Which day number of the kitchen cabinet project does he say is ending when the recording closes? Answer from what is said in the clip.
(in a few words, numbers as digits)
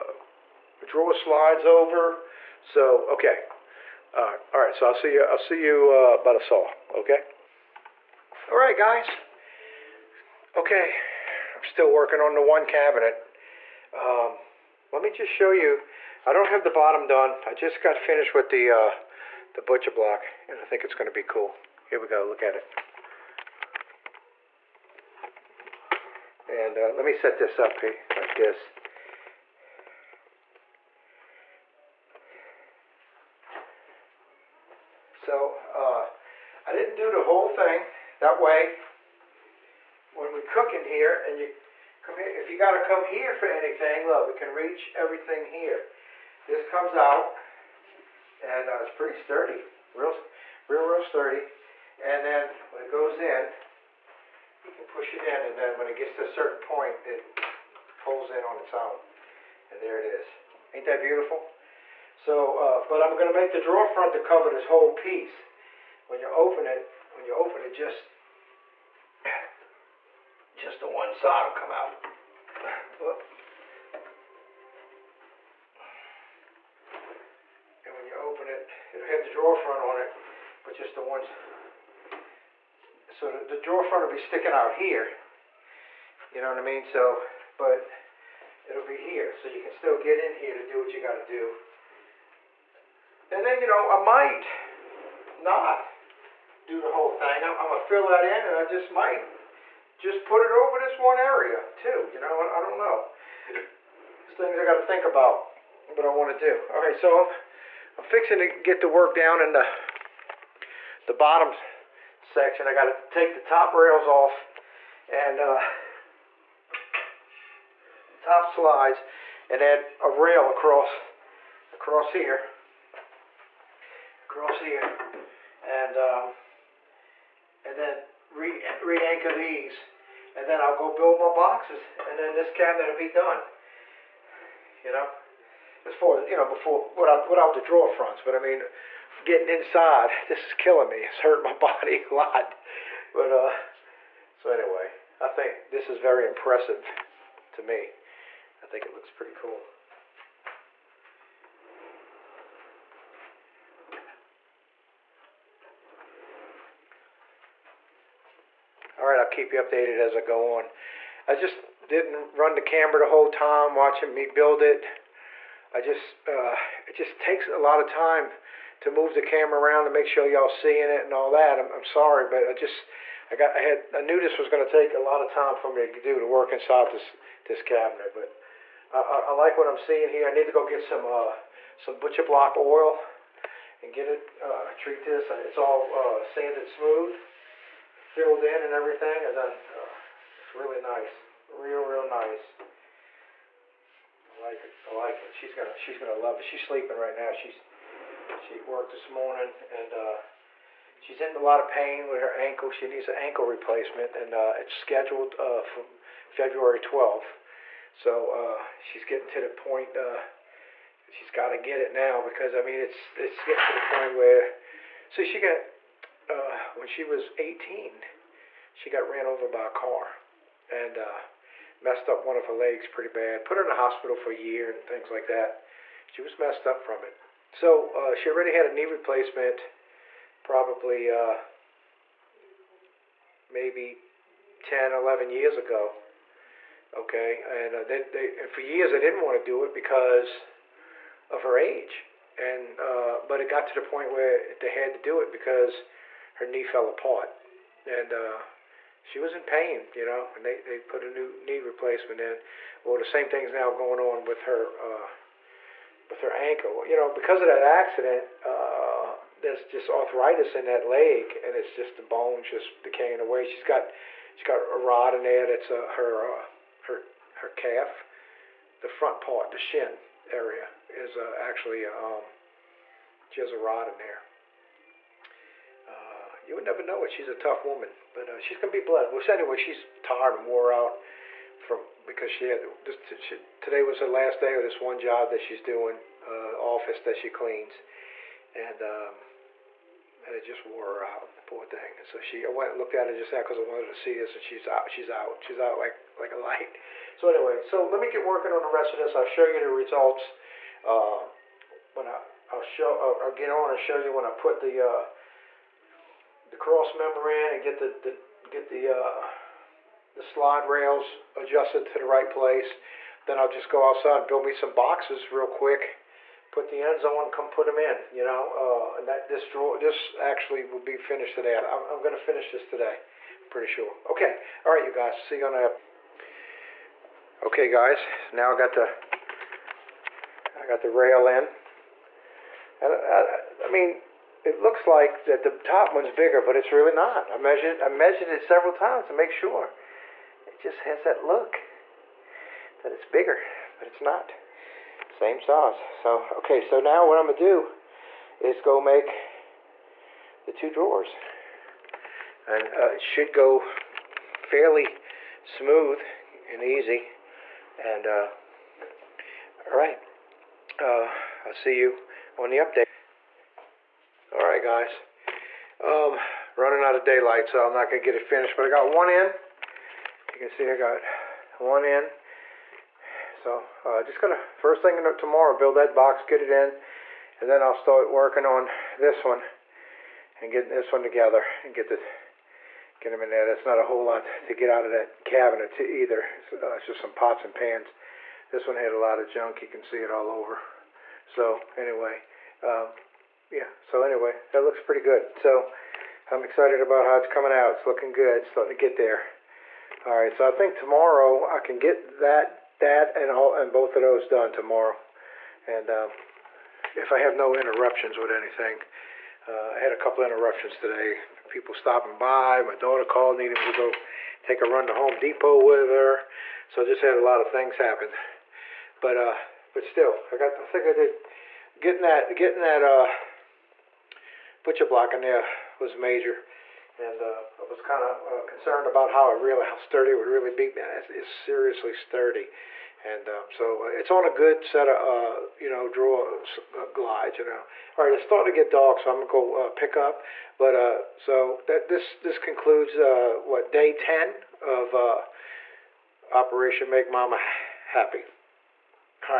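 day 10.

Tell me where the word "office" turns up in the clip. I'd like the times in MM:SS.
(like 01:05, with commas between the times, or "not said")
04:46.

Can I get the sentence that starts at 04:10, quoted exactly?
And they, they put a new knee replacement in.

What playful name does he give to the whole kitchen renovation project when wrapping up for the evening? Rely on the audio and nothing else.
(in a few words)
Operation Make Mama Happy.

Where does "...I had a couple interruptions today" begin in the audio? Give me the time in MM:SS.
06:49.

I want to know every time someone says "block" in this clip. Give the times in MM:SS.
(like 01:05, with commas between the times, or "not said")
00:19, 03:02, 07:04.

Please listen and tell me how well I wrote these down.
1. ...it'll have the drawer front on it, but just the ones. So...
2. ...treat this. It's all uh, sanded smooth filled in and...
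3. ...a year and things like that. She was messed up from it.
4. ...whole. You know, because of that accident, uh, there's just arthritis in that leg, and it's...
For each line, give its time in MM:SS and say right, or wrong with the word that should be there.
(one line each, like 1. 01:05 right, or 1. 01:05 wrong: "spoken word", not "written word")
1. 01:18 right
2. 03:04 right
3. 03:44 right
4. 04:16 wrong: "ankle", not "whole".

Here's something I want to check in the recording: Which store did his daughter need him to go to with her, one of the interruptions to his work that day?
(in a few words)
Home Depot.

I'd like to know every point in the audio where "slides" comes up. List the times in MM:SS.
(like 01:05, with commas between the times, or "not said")
00:01, 01:58, 05:10.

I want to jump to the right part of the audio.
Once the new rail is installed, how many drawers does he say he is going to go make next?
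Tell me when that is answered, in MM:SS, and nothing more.
05:50.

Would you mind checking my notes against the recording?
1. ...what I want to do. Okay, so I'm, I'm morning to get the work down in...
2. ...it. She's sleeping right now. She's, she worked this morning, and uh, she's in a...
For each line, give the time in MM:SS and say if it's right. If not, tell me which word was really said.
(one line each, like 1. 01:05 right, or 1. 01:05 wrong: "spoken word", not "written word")
1. 01:45 wrong: "fixing", not "morning"
2. 03:16 right.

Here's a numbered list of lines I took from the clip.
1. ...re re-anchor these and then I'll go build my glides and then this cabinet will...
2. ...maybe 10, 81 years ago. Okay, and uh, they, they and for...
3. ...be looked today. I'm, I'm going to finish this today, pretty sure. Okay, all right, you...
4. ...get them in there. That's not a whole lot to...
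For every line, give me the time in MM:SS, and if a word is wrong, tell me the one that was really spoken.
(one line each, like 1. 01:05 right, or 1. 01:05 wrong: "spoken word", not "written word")
1. 02:08 wrong: "boxes", not "glides"
2. 03:53 wrong: "11", not "81"
3. 05:20 wrong: "finished", not "looked"
4. 06:22 right.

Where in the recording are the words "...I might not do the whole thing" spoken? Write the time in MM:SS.
01:33.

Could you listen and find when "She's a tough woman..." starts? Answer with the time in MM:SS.
04:37.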